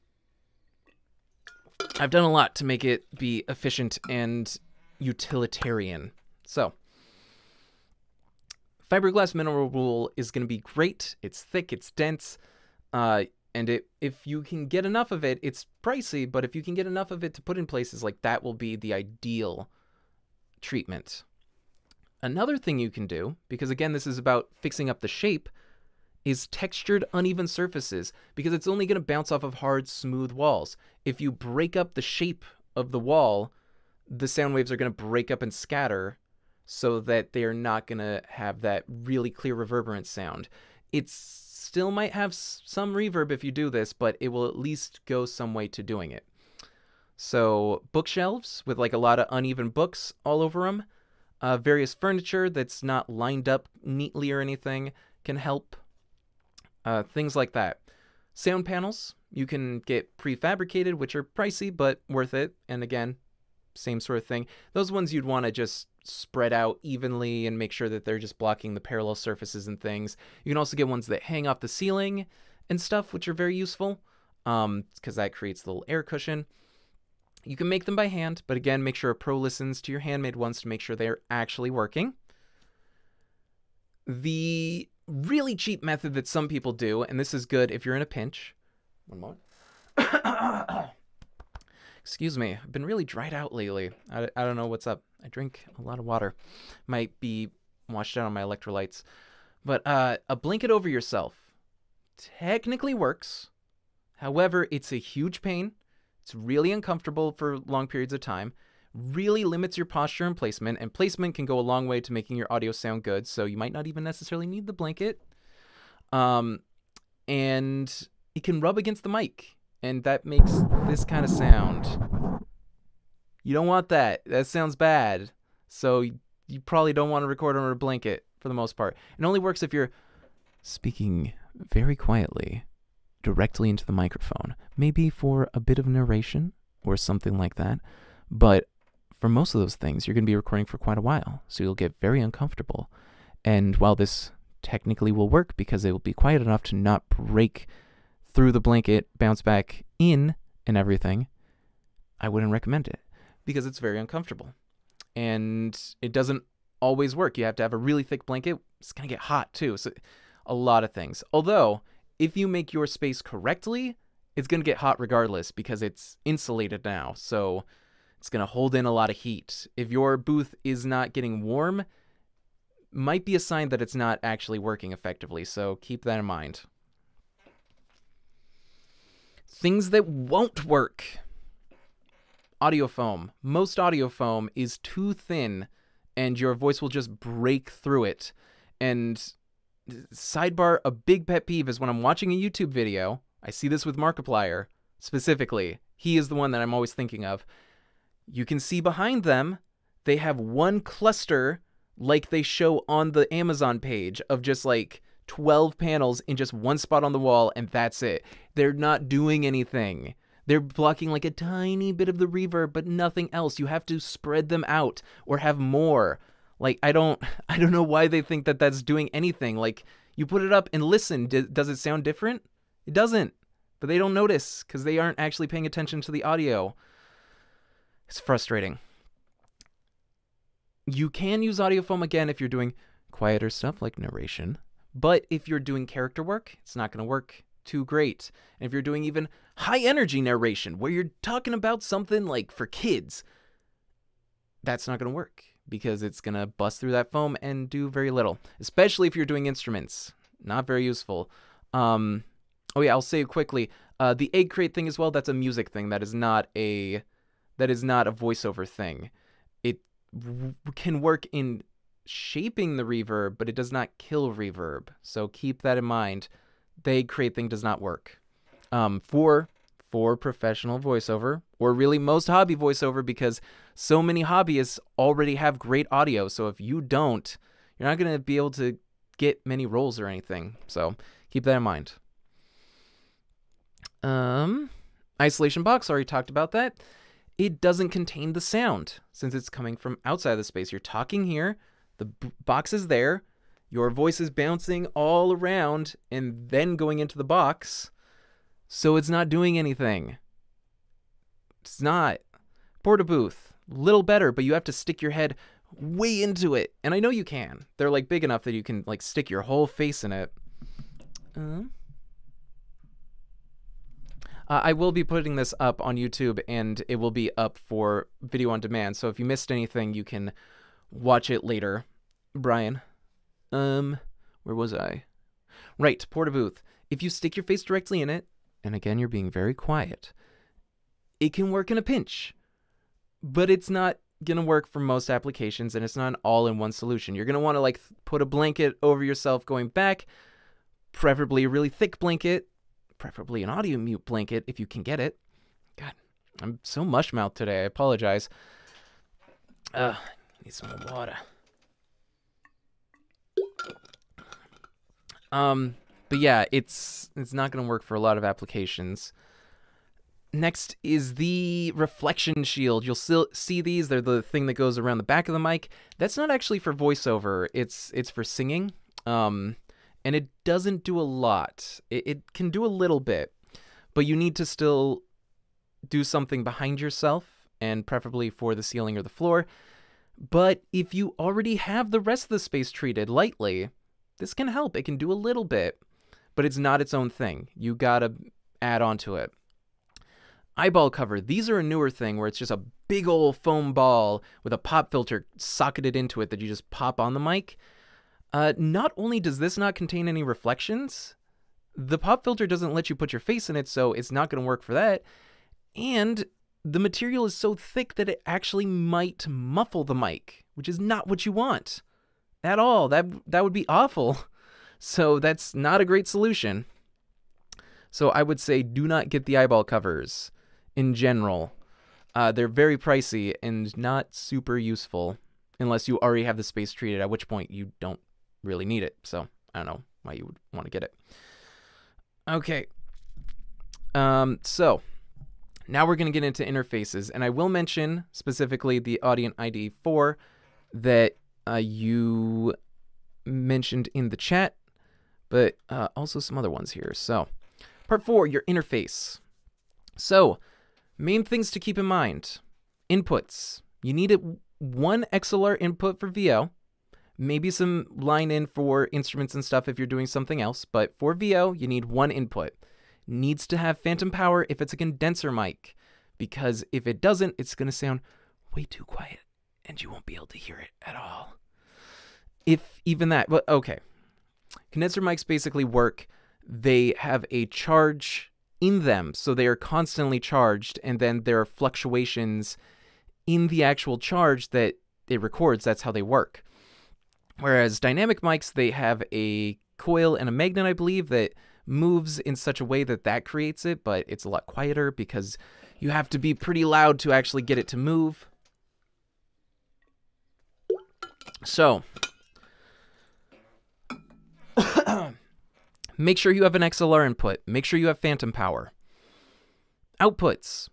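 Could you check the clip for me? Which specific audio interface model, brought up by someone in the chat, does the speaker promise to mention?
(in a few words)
Audient ID 4.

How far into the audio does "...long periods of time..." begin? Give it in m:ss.
1:47.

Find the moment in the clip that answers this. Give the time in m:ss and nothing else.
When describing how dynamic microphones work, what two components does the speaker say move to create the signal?
8:09.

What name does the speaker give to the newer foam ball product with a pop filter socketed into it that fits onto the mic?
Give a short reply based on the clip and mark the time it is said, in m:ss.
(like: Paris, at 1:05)
eyeball cover, at 6:30.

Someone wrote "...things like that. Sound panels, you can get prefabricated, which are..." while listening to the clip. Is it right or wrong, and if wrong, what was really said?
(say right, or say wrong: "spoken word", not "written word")
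right.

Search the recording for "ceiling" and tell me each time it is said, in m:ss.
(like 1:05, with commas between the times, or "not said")
1:11, 6:18.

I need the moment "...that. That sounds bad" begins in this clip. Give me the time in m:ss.
2:03.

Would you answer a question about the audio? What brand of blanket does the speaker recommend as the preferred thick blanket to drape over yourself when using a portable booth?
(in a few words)
Audimute.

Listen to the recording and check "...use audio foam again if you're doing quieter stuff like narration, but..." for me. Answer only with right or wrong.
right.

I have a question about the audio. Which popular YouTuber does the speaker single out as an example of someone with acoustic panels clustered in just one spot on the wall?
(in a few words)
Markiplier.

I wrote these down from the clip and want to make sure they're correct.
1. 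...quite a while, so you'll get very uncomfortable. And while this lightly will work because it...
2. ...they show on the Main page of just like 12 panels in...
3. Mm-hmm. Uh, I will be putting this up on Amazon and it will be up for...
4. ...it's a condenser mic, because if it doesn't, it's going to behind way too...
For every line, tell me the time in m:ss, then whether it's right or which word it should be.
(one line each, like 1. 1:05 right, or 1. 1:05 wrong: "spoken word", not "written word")
1. 2:20 wrong: "technically", not "lightly"
2. 3:22 wrong: "Amazon", not "Main"
3. 5:11 wrong: "YouTube", not "Amazon"
4. 7:44 wrong: "sound", not "behind".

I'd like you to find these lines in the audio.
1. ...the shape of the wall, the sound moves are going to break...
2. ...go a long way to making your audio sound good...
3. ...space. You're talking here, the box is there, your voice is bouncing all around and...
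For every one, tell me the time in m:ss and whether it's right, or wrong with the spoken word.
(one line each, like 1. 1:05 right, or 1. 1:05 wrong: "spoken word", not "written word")
1. 0:31 wrong: "waves", not "moves"
2. 1:51 right
3. 4:50 right.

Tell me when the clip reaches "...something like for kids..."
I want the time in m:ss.
4:01.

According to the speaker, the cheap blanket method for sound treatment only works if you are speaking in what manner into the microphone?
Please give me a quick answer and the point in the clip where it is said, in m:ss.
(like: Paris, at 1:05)
very quietly, at 2:11.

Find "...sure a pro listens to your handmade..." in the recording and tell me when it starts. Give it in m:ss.
1:18.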